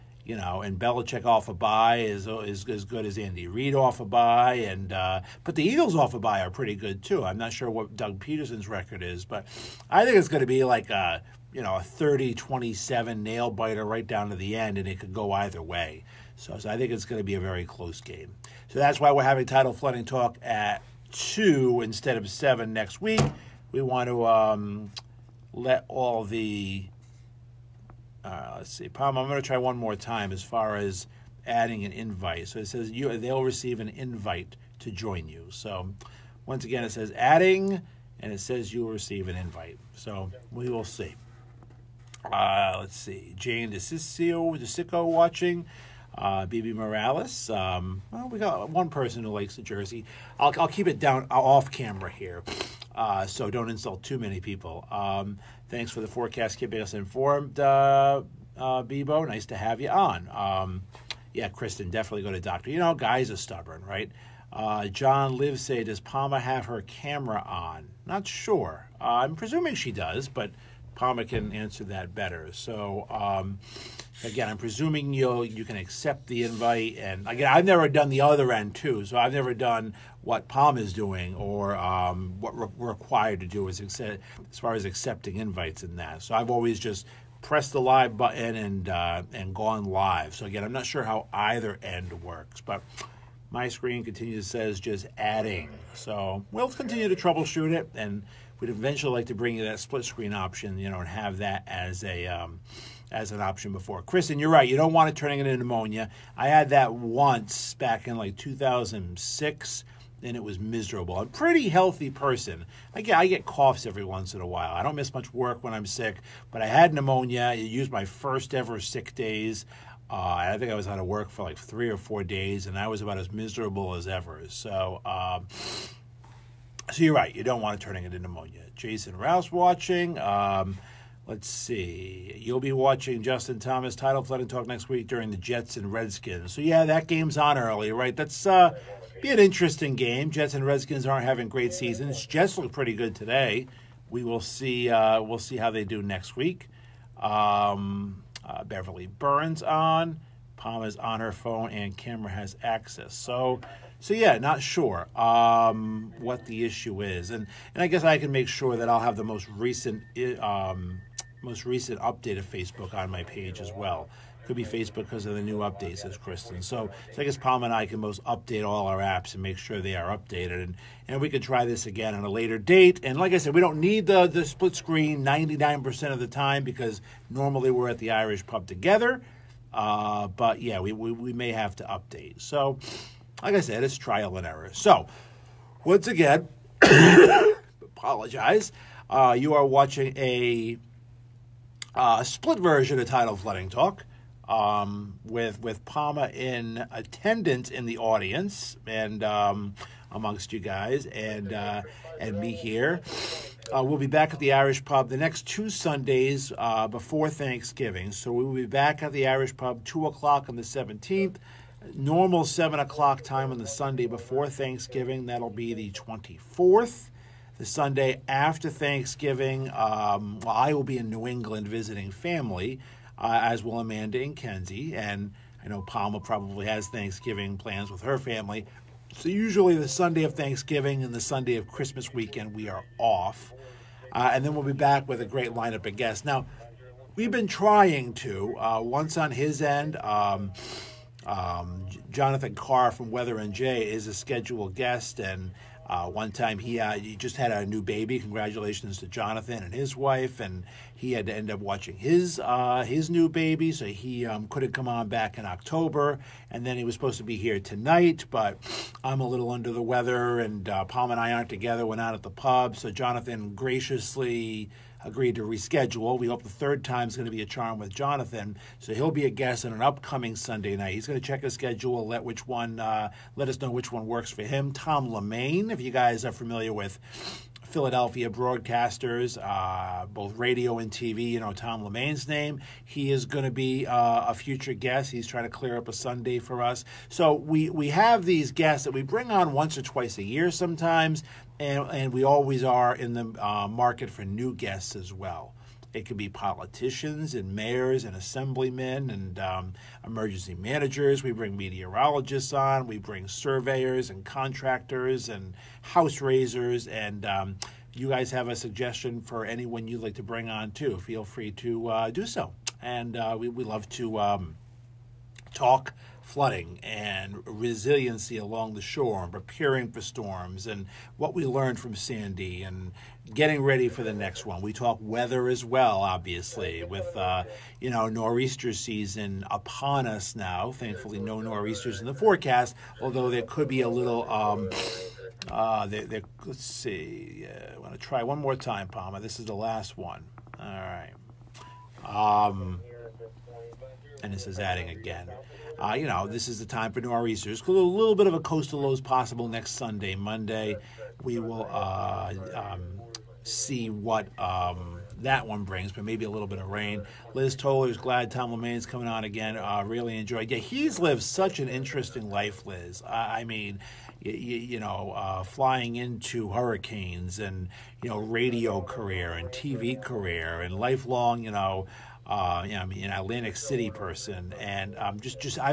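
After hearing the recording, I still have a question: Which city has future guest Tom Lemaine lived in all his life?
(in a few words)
Atlantic City.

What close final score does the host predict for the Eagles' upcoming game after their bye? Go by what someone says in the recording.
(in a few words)
30-27.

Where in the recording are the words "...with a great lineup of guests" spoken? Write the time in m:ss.
3:55.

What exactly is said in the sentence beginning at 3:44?
And I know Palma probably has Thanksgiving plans with her family.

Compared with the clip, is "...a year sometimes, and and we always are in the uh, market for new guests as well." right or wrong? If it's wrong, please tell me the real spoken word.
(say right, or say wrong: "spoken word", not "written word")
right.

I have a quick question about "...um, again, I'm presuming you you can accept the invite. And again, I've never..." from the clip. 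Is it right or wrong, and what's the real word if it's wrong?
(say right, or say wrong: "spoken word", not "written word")
right.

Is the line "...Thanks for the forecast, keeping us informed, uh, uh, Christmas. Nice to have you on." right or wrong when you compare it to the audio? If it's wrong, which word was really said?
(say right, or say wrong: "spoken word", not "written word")
wrong: "Bebo", not "Christmas".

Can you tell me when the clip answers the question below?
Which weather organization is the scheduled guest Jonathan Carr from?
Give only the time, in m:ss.
4:03.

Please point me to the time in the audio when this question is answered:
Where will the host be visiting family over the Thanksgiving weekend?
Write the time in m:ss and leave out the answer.
3:41.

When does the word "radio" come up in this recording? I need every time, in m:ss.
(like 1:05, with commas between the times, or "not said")
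4:40, 6:08.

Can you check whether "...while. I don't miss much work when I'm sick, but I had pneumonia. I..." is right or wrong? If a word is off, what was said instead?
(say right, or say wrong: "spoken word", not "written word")
right.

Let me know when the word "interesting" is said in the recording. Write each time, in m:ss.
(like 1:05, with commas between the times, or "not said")
2:19, 6:01.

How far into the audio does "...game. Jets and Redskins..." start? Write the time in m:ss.
2:19.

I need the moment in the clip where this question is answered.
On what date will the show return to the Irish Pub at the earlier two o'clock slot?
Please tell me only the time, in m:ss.
3:30.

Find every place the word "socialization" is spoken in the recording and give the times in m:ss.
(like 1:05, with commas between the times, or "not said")
not said.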